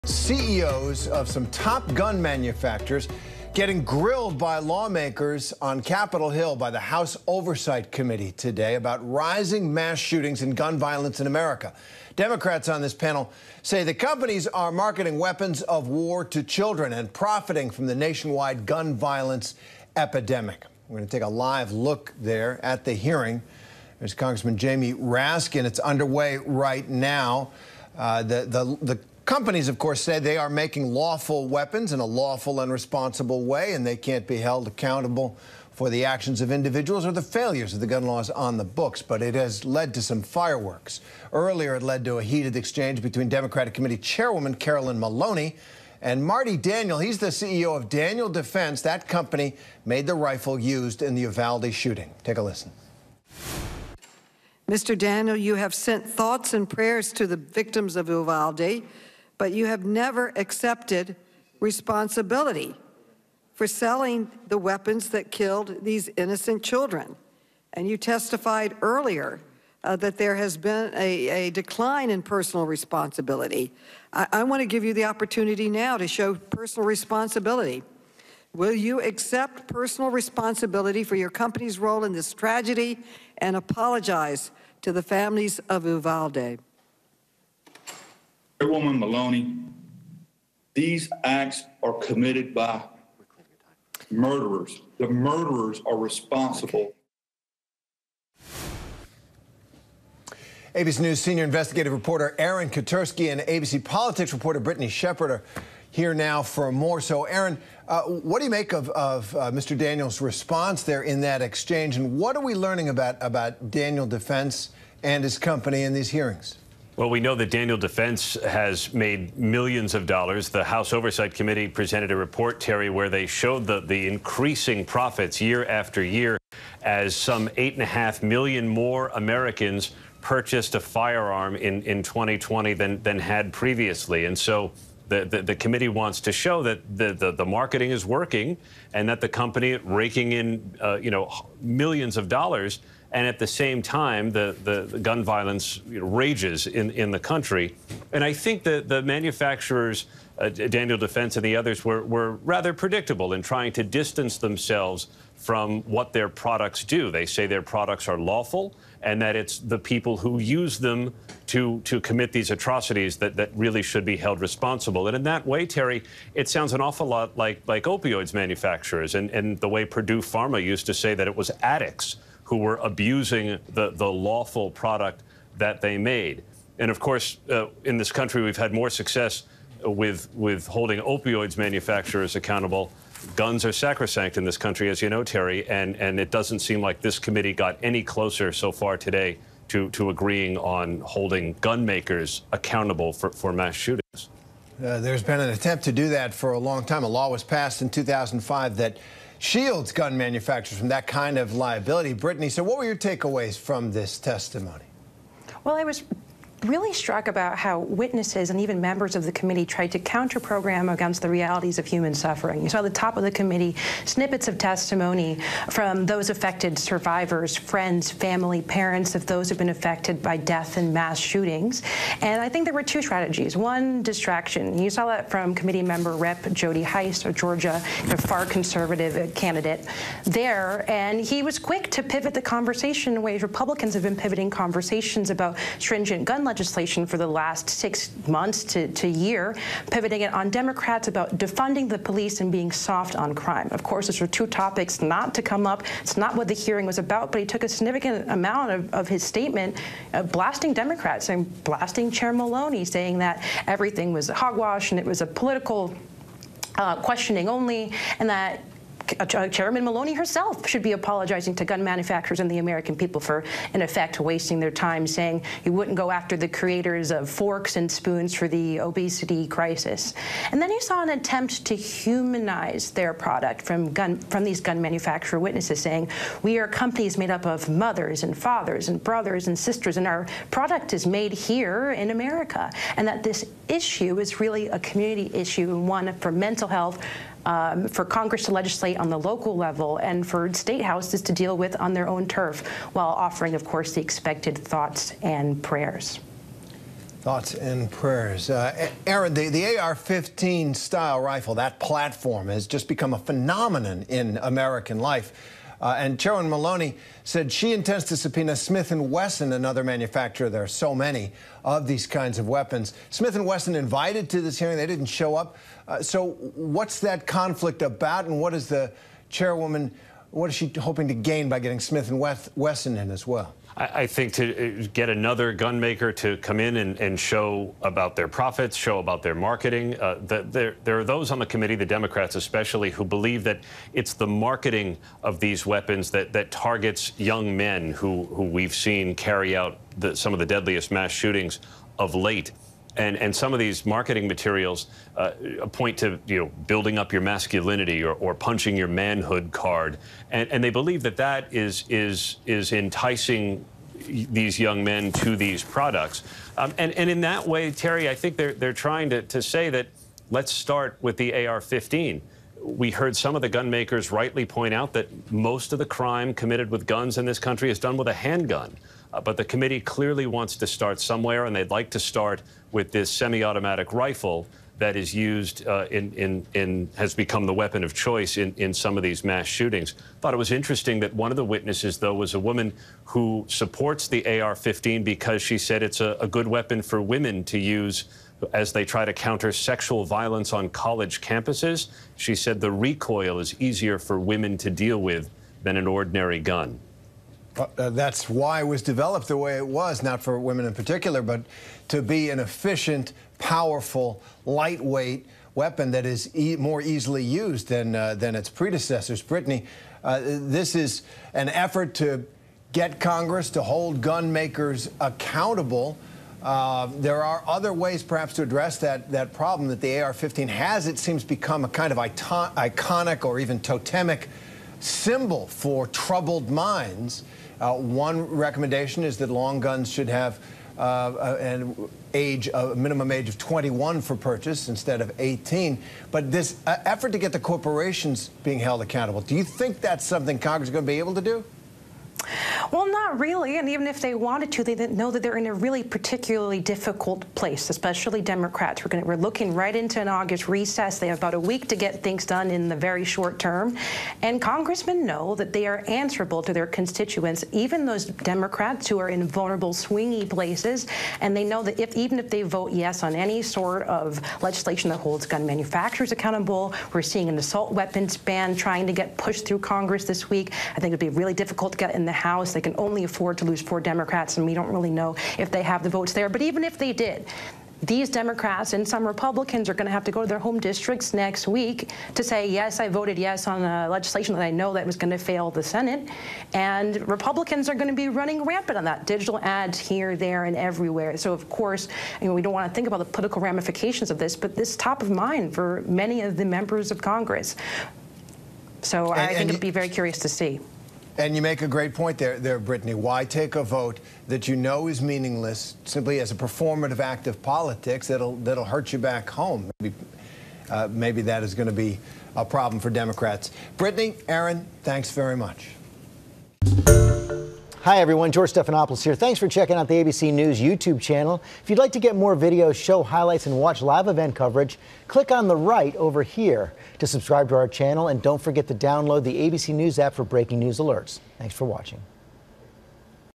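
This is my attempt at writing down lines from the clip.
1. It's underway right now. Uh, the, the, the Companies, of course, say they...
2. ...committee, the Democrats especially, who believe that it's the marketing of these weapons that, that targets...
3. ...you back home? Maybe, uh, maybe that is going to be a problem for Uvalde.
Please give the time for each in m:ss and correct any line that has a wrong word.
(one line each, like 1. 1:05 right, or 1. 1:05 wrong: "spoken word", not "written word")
1. 0:25 right
2. 5:31 right
3. 8:28 wrong: "Democrats", not "Uvalde".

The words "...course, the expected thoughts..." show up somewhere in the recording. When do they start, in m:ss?
4:53.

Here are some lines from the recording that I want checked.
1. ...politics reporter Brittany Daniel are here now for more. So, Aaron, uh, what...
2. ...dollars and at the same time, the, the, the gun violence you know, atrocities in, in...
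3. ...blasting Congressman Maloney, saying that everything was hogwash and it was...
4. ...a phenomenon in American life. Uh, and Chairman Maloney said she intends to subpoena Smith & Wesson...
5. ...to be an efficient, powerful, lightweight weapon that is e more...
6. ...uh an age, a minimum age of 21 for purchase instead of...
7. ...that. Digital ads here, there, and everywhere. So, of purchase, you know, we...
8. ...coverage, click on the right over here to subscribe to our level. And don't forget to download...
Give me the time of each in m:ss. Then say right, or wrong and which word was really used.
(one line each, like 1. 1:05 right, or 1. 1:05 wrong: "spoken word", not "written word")
1. 1:43 wrong: "Shepherd", not "Daniel"
2. 2:22 wrong: "rages", not "atrocities"
3. 4:11 wrong: "Chair", not "Congressman"
4. 5:03 right
5. 6:41 right
6. 7:10 right
7. 8:08 wrong: "course", not "purchase"
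8. 8:44 wrong: "channel", not "level".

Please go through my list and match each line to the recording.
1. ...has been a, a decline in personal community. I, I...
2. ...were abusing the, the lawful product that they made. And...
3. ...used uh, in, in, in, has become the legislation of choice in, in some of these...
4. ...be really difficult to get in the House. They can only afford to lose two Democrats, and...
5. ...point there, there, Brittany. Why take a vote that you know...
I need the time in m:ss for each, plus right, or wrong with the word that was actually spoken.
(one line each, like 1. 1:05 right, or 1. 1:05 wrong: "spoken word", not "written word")
1. 1:10 wrong: "responsibility", not "community"
2. 2:52 right
3. 6:15 wrong: "weapon", not "legislation"
4. 7:51 wrong: "four", not "two"
5. 8:21 right.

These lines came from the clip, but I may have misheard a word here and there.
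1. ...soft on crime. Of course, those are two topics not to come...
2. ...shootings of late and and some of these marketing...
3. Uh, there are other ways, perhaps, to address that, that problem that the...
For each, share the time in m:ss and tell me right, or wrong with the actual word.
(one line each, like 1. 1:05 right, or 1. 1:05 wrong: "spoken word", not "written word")
1. 4:02 right
2. 5:41 right
3. 6:56 right.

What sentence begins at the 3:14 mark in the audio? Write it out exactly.
Uh, there's been an attempt to do that for a long time.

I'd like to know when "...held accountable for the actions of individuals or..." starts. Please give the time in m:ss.
0:34.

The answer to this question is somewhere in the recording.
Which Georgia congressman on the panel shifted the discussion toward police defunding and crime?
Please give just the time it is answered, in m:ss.
3:46.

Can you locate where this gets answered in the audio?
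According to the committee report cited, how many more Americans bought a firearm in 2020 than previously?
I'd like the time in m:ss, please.
2:07.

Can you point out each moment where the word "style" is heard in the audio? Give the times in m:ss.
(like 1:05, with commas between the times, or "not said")
5:00.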